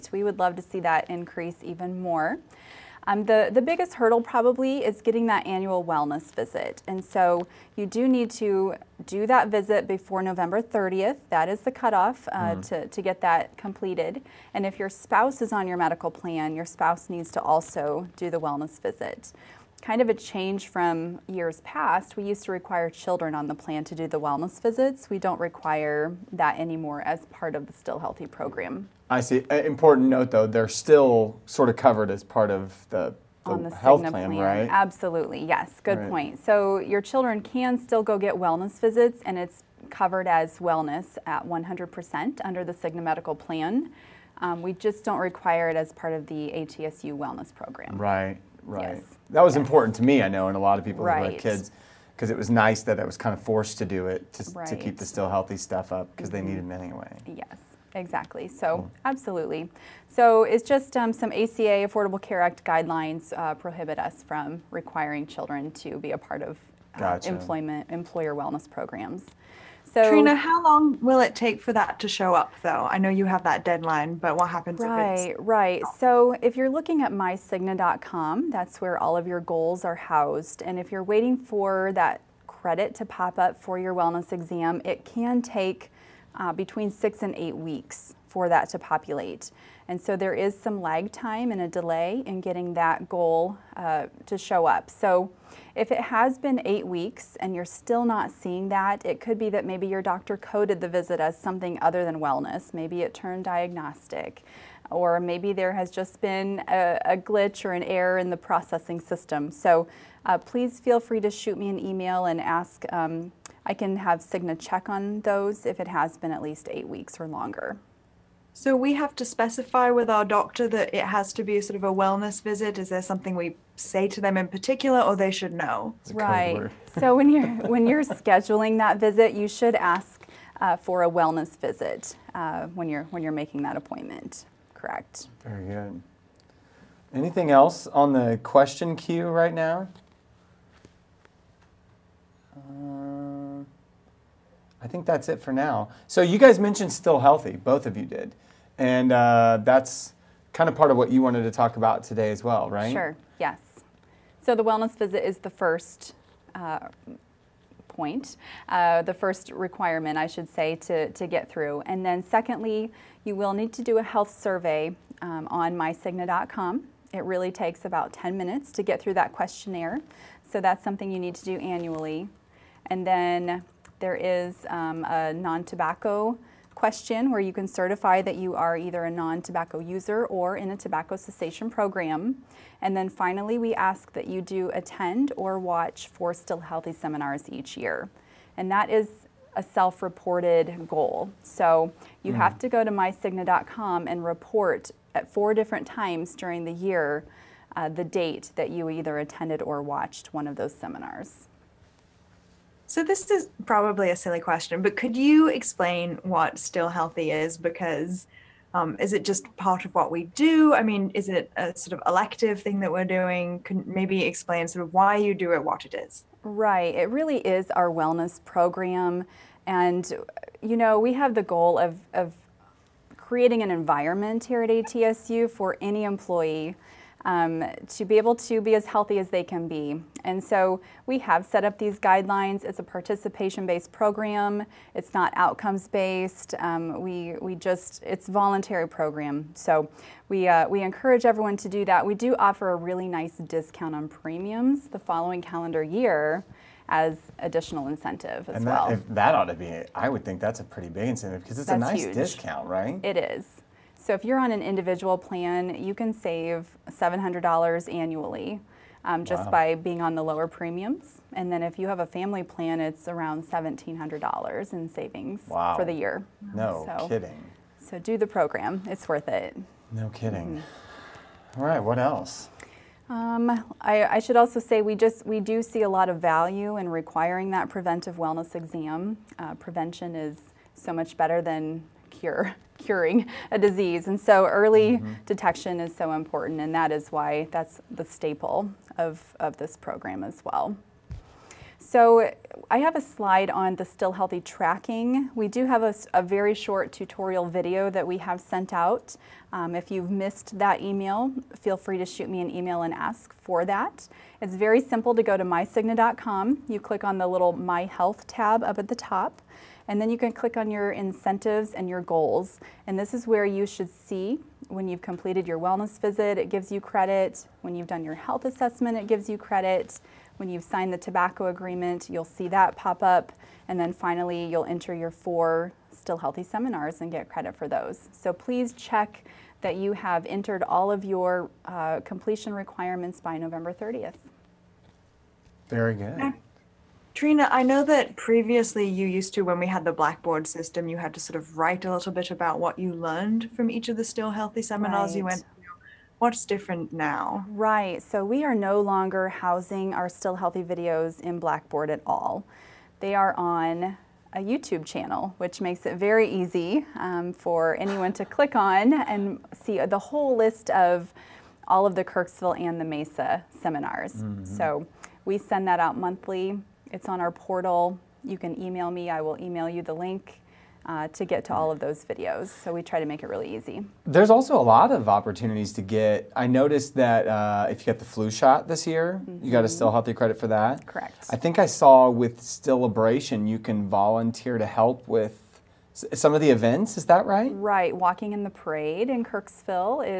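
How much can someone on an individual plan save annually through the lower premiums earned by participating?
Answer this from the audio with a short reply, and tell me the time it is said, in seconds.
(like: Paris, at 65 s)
$700, at 256 s.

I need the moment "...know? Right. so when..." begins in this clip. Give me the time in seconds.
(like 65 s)
125 s.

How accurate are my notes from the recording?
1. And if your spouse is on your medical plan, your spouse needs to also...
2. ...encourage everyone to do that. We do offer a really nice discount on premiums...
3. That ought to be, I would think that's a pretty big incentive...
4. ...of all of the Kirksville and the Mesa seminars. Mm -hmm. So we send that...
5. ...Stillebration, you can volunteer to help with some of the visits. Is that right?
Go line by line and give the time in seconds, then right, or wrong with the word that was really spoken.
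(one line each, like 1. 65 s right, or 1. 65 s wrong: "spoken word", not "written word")
1. 14 s right
2. 240 s right
3. 249 s right
4. 360 s right
5. 382 s wrong: "events", not "visits".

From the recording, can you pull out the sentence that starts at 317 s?
When you've done your health assessment, it gives you credit.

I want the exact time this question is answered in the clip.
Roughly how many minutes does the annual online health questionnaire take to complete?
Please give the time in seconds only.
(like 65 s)
168 s.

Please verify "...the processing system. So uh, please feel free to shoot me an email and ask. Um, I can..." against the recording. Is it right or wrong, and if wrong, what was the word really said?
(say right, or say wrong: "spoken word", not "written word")
right.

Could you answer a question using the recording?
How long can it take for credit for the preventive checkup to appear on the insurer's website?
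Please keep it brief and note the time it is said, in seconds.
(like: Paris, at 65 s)
6 to 8 weeks, at 86 s.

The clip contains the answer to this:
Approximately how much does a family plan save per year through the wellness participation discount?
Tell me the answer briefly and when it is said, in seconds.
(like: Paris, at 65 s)
$1,700, at 263 s.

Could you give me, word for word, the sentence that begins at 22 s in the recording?
We used to require children on the plan to do the wellness visits.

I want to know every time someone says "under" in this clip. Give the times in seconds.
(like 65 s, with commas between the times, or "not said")
42 s.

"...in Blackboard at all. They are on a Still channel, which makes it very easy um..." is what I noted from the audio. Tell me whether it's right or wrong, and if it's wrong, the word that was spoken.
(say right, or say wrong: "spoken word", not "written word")
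wrong: "YouTube", not "Still".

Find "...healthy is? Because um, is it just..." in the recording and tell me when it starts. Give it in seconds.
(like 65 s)
206 s.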